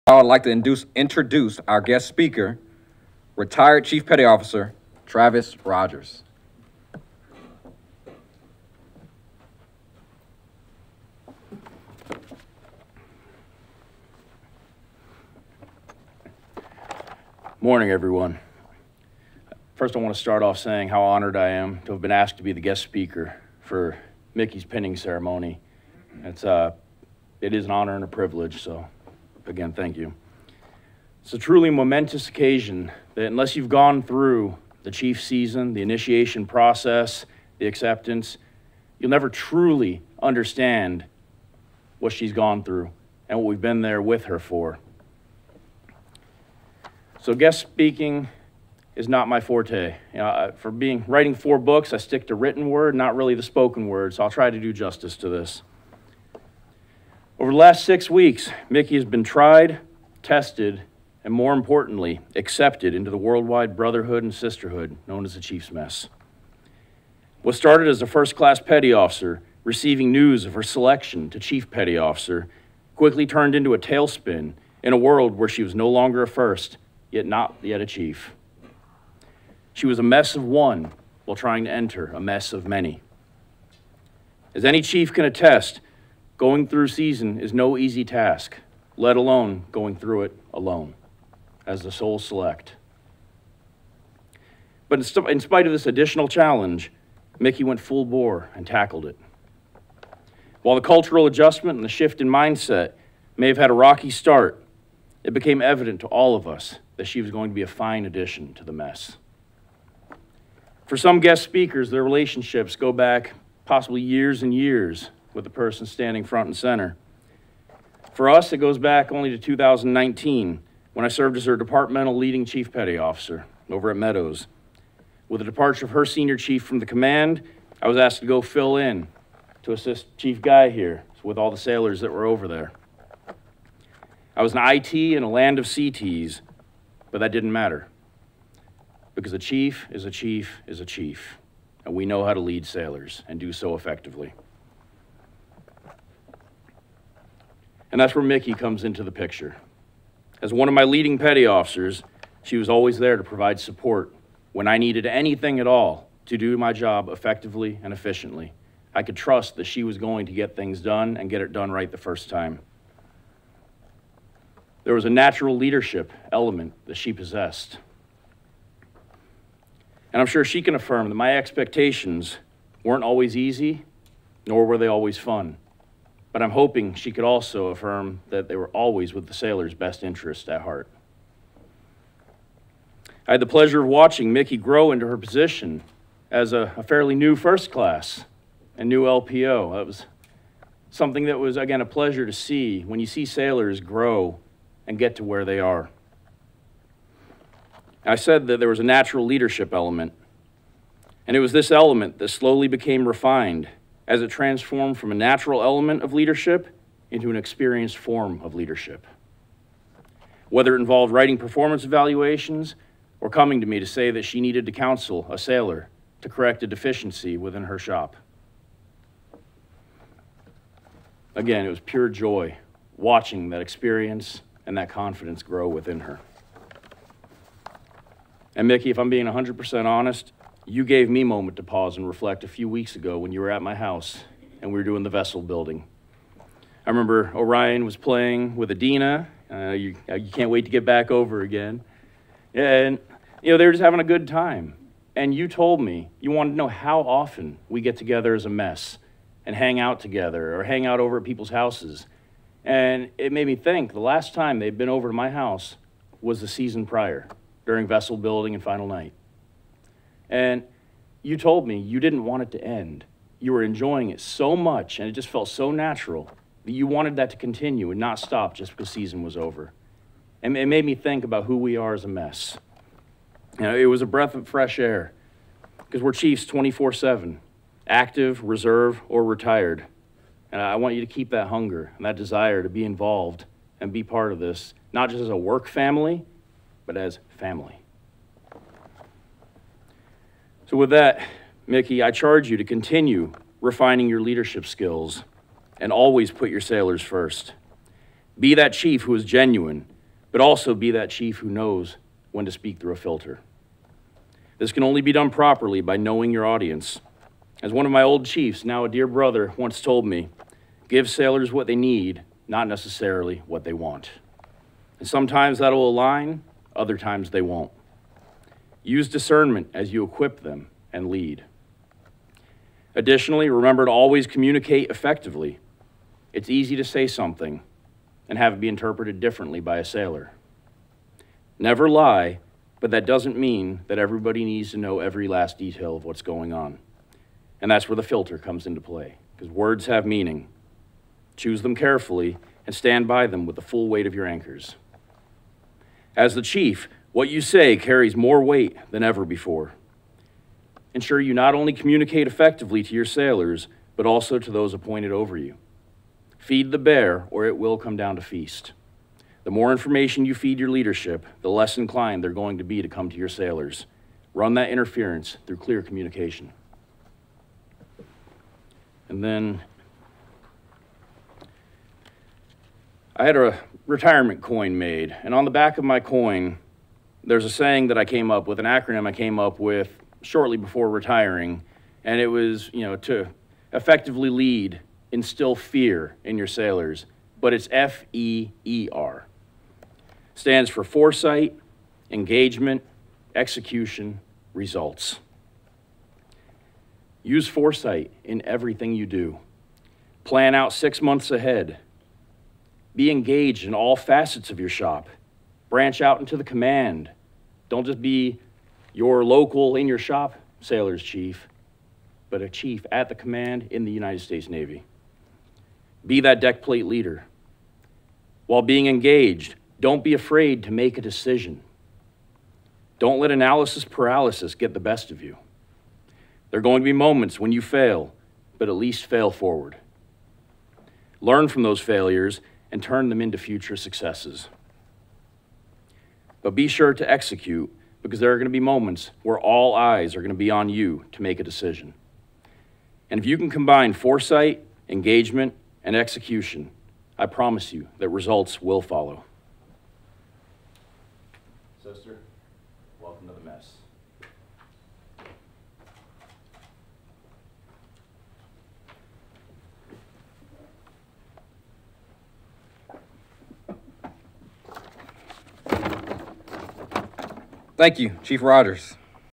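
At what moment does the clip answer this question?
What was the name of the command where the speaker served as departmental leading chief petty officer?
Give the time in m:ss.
2:03.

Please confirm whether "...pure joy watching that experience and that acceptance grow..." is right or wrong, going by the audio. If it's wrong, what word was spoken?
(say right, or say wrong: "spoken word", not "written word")
wrong: "confidence", not "acceptance".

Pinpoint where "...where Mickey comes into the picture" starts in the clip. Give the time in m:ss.
2:28.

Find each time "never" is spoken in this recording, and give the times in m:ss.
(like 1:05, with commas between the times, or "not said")
0:39, 5:31.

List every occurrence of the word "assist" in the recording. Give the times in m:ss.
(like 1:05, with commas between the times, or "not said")
2:09.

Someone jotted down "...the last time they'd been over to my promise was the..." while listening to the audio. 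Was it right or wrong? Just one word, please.
wrong.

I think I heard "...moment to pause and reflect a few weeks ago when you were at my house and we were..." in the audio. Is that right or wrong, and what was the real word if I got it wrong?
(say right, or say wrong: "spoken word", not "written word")
right.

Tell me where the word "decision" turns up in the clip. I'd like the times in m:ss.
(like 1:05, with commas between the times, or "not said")
7:01, 7:21.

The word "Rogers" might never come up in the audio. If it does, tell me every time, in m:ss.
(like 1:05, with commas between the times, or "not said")
0:05, 7:48.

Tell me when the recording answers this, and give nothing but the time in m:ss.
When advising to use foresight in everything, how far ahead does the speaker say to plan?
6:40.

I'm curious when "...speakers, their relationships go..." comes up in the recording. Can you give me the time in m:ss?
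1:51.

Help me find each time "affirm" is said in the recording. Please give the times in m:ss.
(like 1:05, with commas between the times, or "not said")
2:50, 2:57.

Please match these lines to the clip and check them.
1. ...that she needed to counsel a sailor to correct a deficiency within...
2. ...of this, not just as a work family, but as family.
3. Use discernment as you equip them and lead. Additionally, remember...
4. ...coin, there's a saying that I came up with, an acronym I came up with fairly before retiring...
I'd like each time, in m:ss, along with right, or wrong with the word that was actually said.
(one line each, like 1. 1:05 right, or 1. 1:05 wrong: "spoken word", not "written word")
1. 3:34 right
2. 4:44 right
3. 5:18 right
4. 6:15 wrong: "shortly", not "fairly".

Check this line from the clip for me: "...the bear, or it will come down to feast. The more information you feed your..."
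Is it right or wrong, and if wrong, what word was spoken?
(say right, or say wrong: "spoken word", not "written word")
right.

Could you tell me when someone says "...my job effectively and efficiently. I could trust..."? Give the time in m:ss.
2:36.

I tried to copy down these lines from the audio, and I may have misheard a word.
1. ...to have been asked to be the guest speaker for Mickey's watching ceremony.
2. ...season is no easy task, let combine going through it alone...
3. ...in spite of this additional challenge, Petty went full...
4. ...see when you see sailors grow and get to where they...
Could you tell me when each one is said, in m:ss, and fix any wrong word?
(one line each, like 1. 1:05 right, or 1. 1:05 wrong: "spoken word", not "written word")
1. 0:21 wrong: "pinning", not "watching"
2. 1:26 wrong: "alone", not "combine"
3. 1:35 wrong: "Mickey", not "Petty"
4. 3:12 right.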